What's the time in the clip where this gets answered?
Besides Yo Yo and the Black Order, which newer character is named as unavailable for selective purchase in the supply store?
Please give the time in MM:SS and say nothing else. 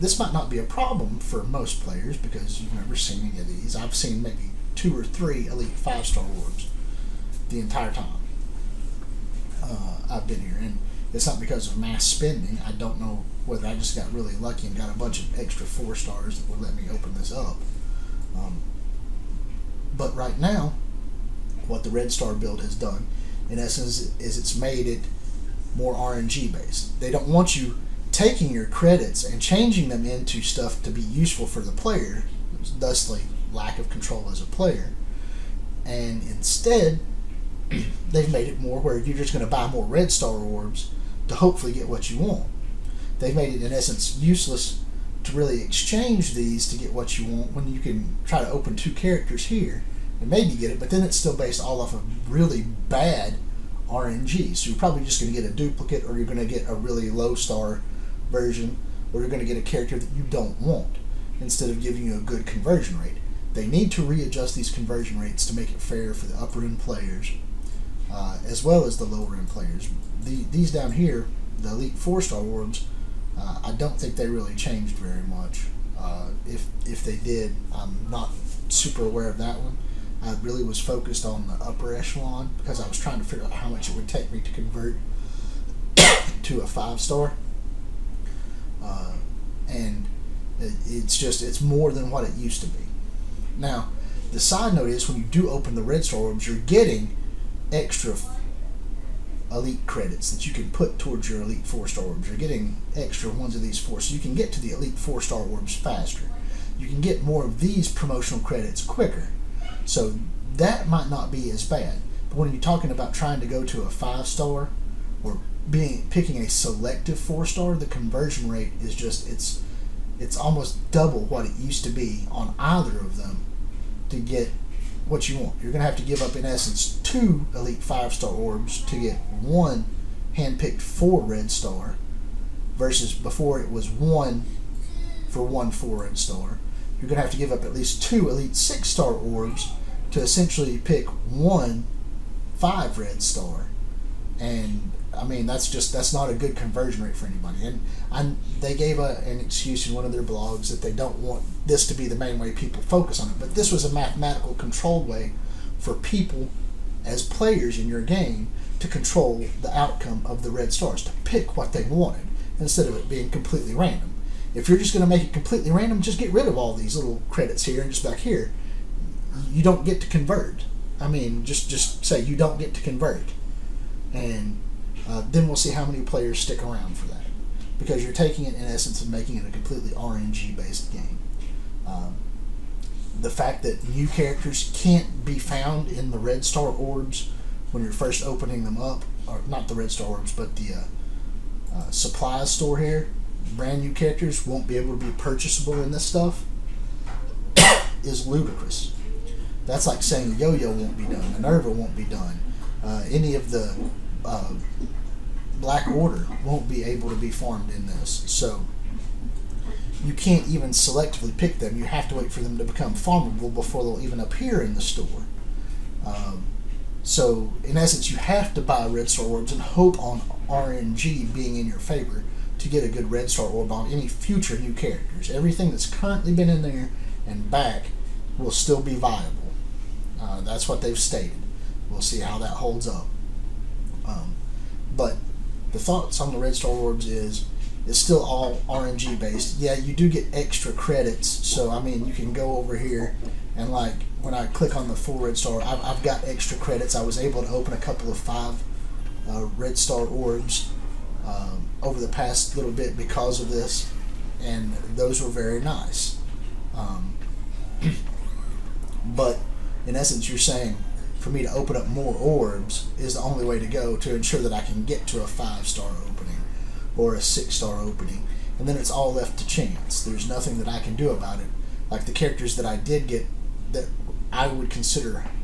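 03:21.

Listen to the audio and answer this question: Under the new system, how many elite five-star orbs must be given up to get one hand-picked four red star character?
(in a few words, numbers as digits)
2.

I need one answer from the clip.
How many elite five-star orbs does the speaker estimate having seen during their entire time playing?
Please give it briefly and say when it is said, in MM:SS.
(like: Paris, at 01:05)
2 or 3, at 00:04.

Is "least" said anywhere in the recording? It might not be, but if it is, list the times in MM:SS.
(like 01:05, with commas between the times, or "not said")
02:17.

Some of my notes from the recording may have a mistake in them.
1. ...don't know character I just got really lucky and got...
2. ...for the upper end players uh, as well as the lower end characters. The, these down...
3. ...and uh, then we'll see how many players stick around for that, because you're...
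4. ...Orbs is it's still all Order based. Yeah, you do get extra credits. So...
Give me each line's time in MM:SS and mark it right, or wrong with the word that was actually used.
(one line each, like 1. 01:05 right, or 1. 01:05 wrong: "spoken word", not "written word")
1. 00:12 wrong: "whether", not "character"
2. 01:06 wrong: "players", not "characters"
3. 02:54 right
4. 03:56 wrong: "RNG", not "Order".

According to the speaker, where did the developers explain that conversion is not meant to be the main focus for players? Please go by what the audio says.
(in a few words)
Their blogs.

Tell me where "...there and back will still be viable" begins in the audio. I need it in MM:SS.
03:46.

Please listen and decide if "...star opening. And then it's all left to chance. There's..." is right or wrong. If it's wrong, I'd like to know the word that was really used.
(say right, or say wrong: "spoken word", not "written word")
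right.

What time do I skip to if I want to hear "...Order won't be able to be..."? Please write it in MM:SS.
03:25.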